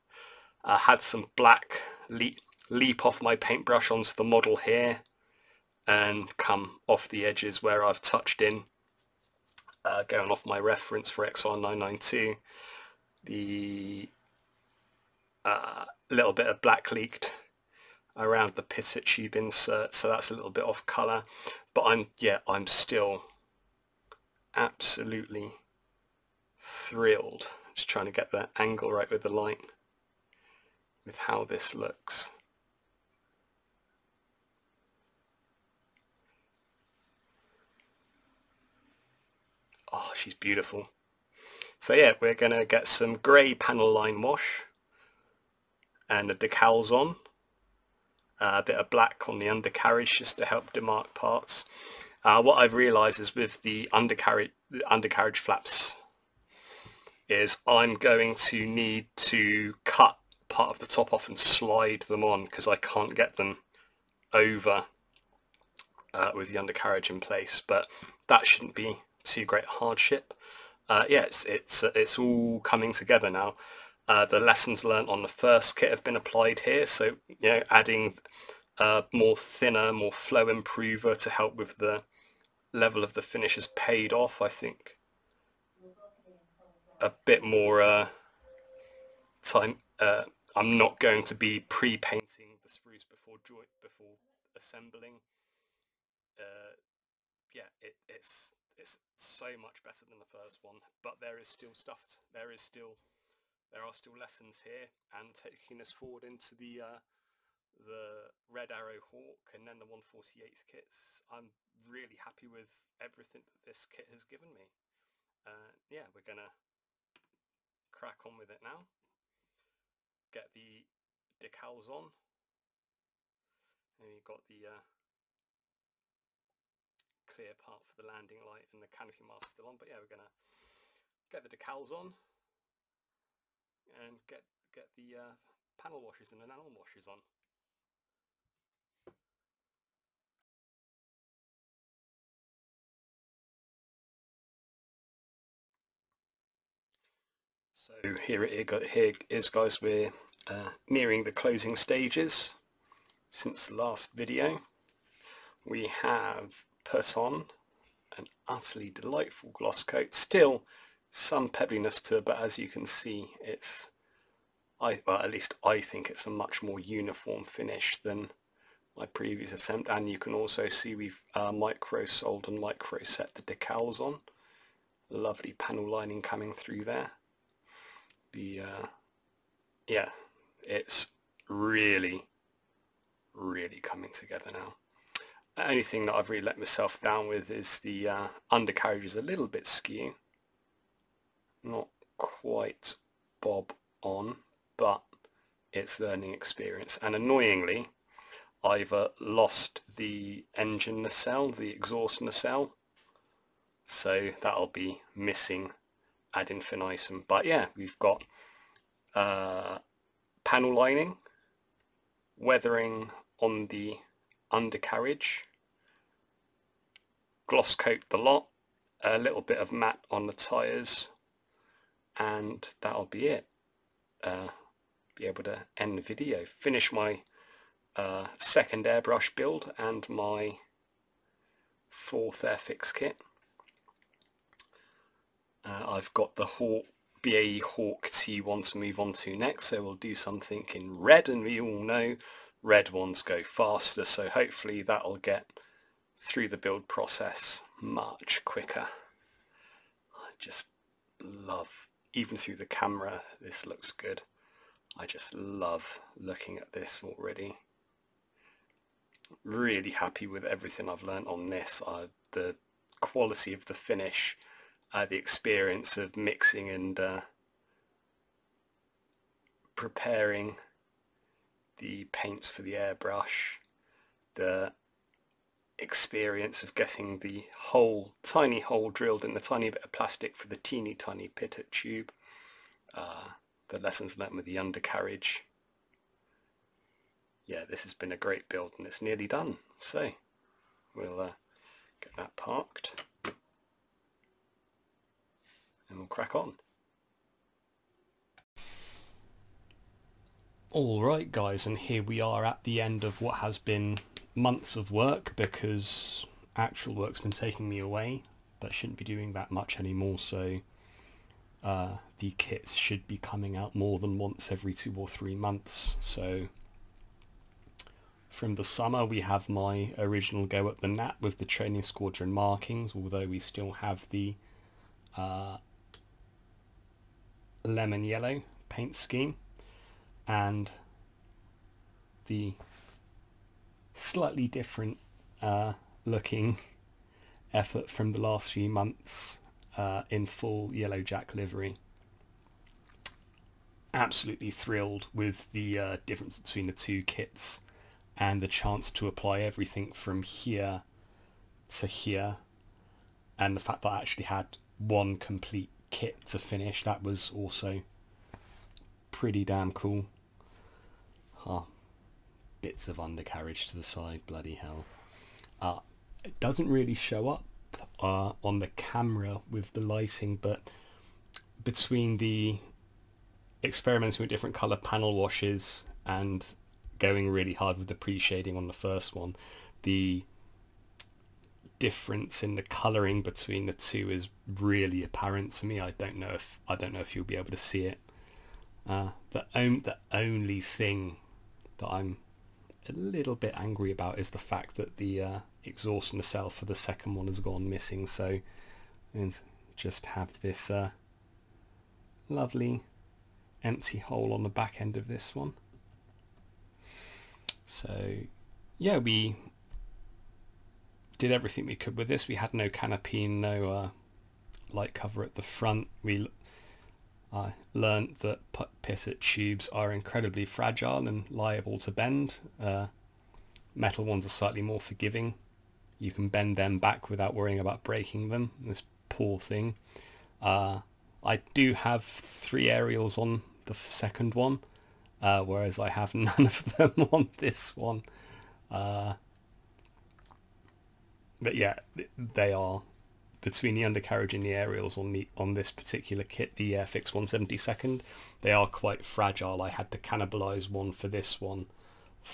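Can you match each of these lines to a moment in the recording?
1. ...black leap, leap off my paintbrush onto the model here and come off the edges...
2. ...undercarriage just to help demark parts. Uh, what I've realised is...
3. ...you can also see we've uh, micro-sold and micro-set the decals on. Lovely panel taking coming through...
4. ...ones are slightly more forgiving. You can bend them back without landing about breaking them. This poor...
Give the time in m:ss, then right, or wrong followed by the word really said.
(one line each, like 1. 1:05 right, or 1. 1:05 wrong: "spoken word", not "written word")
1. 0:01 right
2. 0:49 right
3. 2:50 wrong: "lining", not "taking"
4. 7:04 wrong: "worrying", not "landing".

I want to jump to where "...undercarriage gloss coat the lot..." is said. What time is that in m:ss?
3:34.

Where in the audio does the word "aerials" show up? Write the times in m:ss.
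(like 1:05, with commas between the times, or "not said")
7:12, 7:24.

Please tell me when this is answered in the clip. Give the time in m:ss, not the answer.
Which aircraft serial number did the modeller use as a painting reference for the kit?
0:11.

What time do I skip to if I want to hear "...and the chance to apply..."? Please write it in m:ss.
5:48.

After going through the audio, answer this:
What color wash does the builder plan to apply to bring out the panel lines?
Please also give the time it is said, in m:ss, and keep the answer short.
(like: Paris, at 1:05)
Grey, at 0:43.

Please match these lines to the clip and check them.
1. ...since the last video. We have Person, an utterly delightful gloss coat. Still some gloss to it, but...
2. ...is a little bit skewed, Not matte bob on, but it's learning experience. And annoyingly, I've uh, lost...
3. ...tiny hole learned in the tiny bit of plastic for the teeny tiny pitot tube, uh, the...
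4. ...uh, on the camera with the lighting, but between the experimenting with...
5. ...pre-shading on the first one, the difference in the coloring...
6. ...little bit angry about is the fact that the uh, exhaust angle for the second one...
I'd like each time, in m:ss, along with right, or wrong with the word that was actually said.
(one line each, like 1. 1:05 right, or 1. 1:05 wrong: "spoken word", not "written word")
1. 2:33 wrong: "pebbliness", not "gloss"
2. 3:09 wrong: "quite", not "matte"
3. 4:38 wrong: "drilled", not "learned"
4. 6:08 right
5. 6:17 right
6. 6:32 wrong: "nacelle", not "angle".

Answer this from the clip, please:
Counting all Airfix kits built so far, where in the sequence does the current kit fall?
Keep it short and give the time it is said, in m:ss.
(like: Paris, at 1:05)
4th, at 3:51.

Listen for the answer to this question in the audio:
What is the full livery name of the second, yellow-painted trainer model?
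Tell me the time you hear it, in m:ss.
5:40.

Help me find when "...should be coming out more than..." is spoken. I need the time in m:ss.
5:12.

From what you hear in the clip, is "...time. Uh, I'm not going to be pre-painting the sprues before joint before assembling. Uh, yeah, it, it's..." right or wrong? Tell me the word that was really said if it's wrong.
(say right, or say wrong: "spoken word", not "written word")
right.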